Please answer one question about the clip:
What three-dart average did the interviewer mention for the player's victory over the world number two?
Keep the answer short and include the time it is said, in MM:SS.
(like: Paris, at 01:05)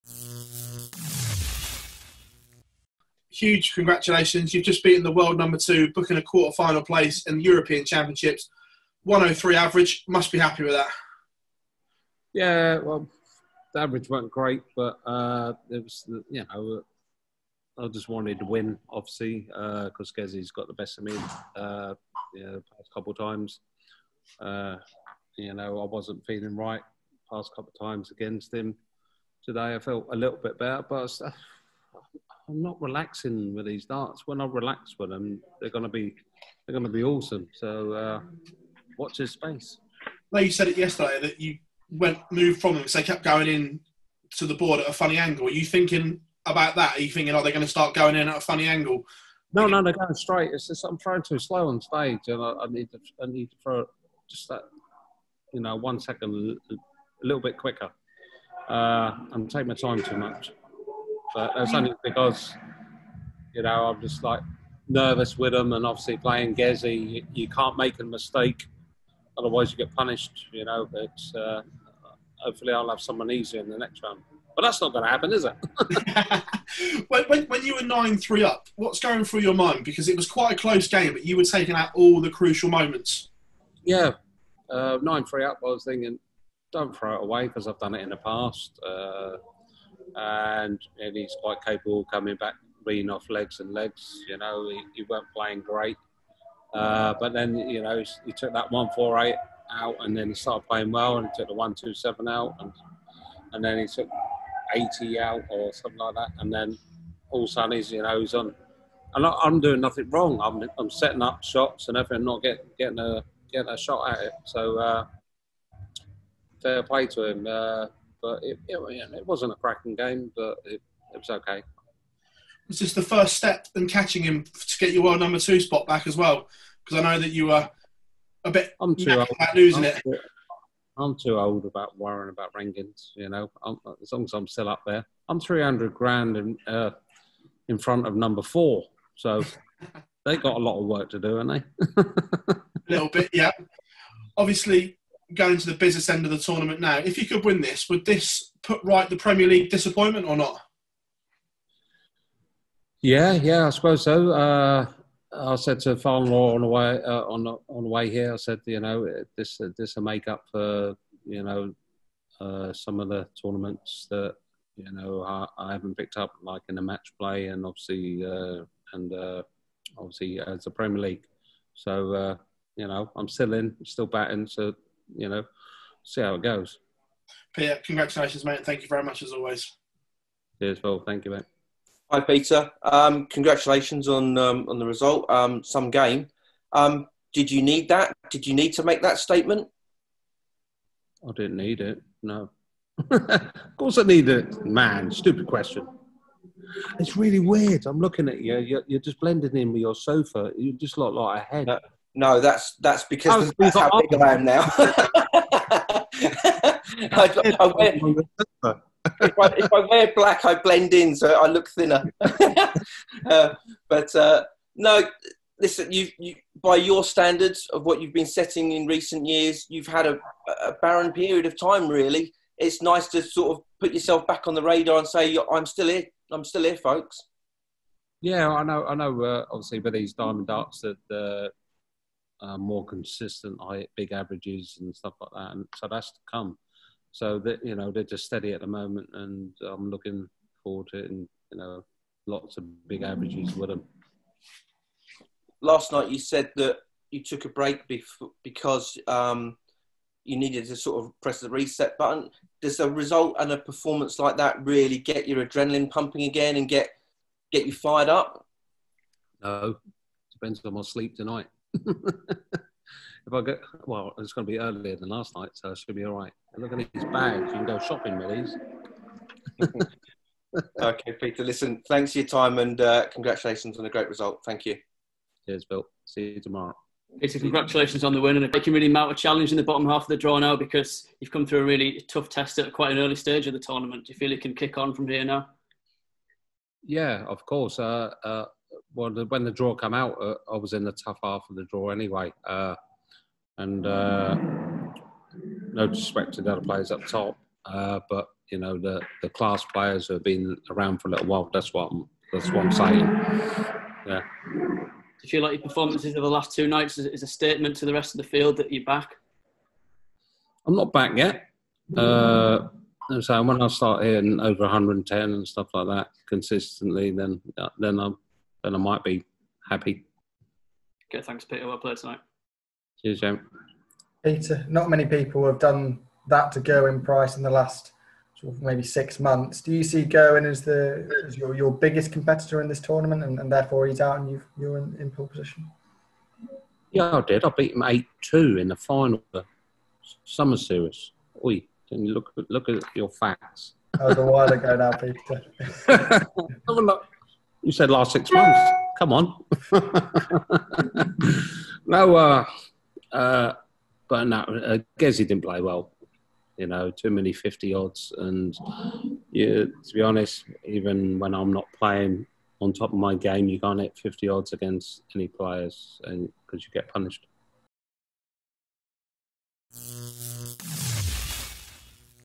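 103, at 00:09.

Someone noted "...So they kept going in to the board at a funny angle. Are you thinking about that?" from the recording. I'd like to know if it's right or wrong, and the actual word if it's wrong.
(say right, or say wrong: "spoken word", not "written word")
right.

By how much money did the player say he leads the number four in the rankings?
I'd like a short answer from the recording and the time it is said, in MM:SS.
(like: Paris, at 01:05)
300 grand, at 02:15.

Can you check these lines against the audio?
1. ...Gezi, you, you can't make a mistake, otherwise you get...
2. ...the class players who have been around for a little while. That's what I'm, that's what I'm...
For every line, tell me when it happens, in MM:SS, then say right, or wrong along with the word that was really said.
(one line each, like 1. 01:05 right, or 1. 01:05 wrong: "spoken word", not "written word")
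1. 01:06 right
2. 04:59 right.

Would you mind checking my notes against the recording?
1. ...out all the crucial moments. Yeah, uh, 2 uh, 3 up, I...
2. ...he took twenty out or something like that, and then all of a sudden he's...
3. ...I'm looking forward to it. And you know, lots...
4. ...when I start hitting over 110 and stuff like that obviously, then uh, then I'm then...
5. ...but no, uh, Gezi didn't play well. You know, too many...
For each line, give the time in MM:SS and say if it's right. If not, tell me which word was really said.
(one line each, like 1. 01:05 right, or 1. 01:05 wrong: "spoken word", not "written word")
1. 01:21 wrong: "9", not "2"
2. 01:43 wrong: "eighty", not "twenty"
3. 03:59 right
4. 05:13 wrong: "consistently", not "obviously"
5. 05:54 right.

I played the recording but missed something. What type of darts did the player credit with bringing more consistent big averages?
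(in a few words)
Diamond darts.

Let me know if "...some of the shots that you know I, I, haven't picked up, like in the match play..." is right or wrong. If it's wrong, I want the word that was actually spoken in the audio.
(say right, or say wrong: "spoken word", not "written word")
wrong: "tournaments", not "shots".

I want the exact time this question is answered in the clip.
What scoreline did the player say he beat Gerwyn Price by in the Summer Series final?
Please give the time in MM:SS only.
05:37.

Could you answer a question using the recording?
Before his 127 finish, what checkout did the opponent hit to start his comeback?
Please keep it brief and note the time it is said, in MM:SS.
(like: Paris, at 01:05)
148, at 01:38.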